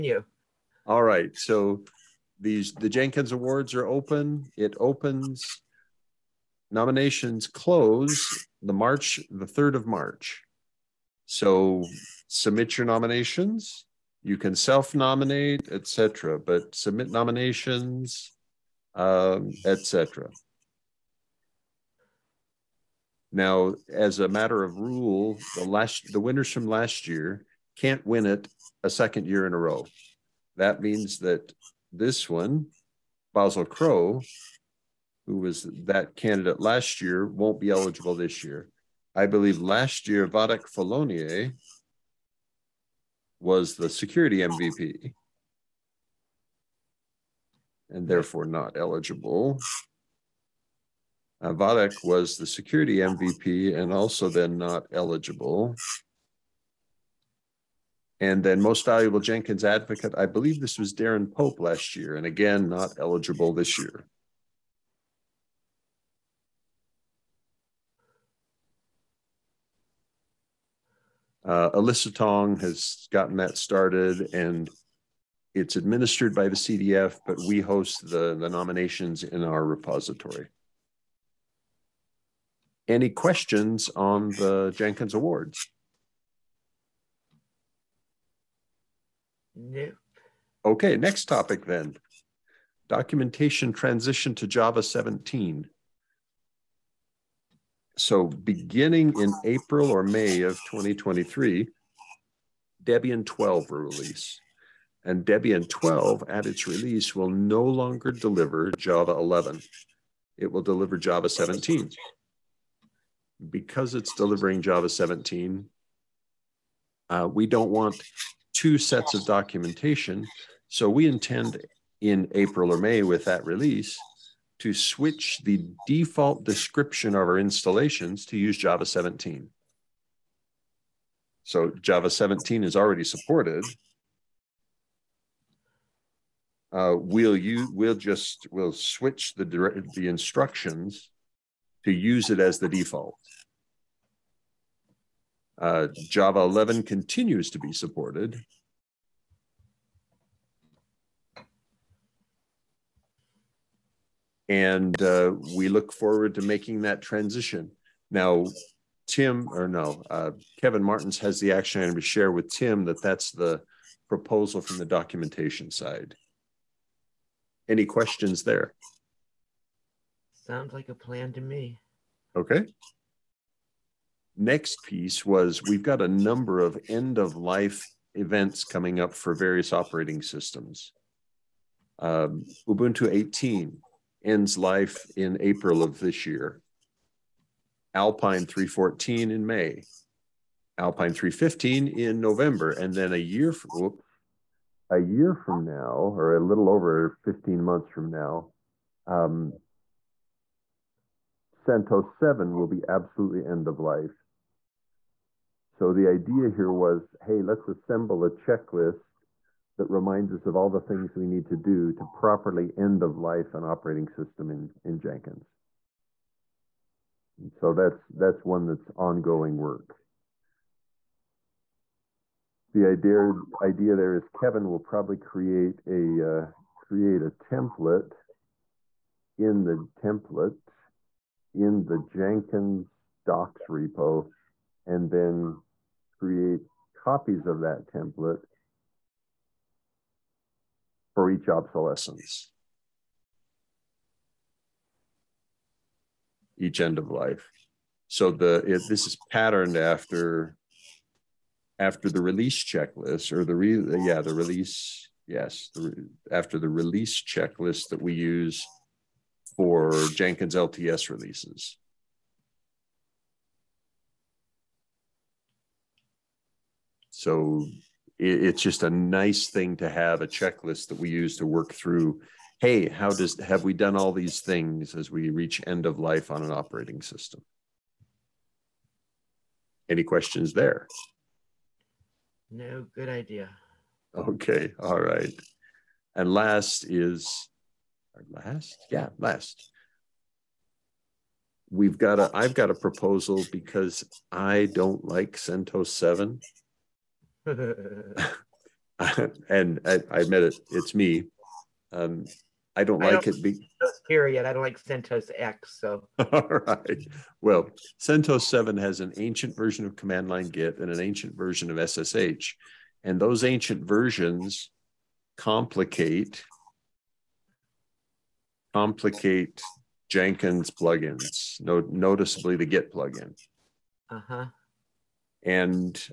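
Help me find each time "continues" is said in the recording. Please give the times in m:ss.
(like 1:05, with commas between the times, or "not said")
2:26.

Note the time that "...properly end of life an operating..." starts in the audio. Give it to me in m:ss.
3:32.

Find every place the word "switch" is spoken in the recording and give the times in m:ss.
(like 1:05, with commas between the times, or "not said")
2:04, 2:18.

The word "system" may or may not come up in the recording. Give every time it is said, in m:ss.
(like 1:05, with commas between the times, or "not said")
3:00, 3:34, 4:37.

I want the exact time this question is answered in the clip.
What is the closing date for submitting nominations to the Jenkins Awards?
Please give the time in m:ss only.
0:09.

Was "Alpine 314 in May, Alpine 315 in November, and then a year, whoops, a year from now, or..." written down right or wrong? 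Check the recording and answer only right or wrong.
right.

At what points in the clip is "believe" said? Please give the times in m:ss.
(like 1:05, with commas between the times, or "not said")
0:39, 1:00.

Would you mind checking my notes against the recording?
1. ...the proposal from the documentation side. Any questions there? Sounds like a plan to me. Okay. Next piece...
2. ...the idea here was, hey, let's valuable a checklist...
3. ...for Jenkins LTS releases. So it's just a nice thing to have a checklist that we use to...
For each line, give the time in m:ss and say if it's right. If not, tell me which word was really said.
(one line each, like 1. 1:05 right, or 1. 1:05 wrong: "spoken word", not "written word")
1. 2:43 right
2. 3:25 wrong: "assemble", not "valuable"
3. 4:19 right.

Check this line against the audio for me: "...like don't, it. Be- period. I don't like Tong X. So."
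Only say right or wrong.
wrong.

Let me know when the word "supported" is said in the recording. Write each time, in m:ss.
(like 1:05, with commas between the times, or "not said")
2:13, 2:27.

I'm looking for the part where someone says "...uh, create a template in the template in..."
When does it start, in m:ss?
3:46.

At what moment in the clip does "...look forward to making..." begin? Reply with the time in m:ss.
2:35.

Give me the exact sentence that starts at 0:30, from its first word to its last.
That means that this one, Basil Crow, who was that candidate last year, won't be eligible this year.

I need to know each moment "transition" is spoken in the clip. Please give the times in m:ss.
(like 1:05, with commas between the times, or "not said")
1:33, 2:37.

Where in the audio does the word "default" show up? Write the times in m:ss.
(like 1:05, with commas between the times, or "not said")
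2:05, 2:22.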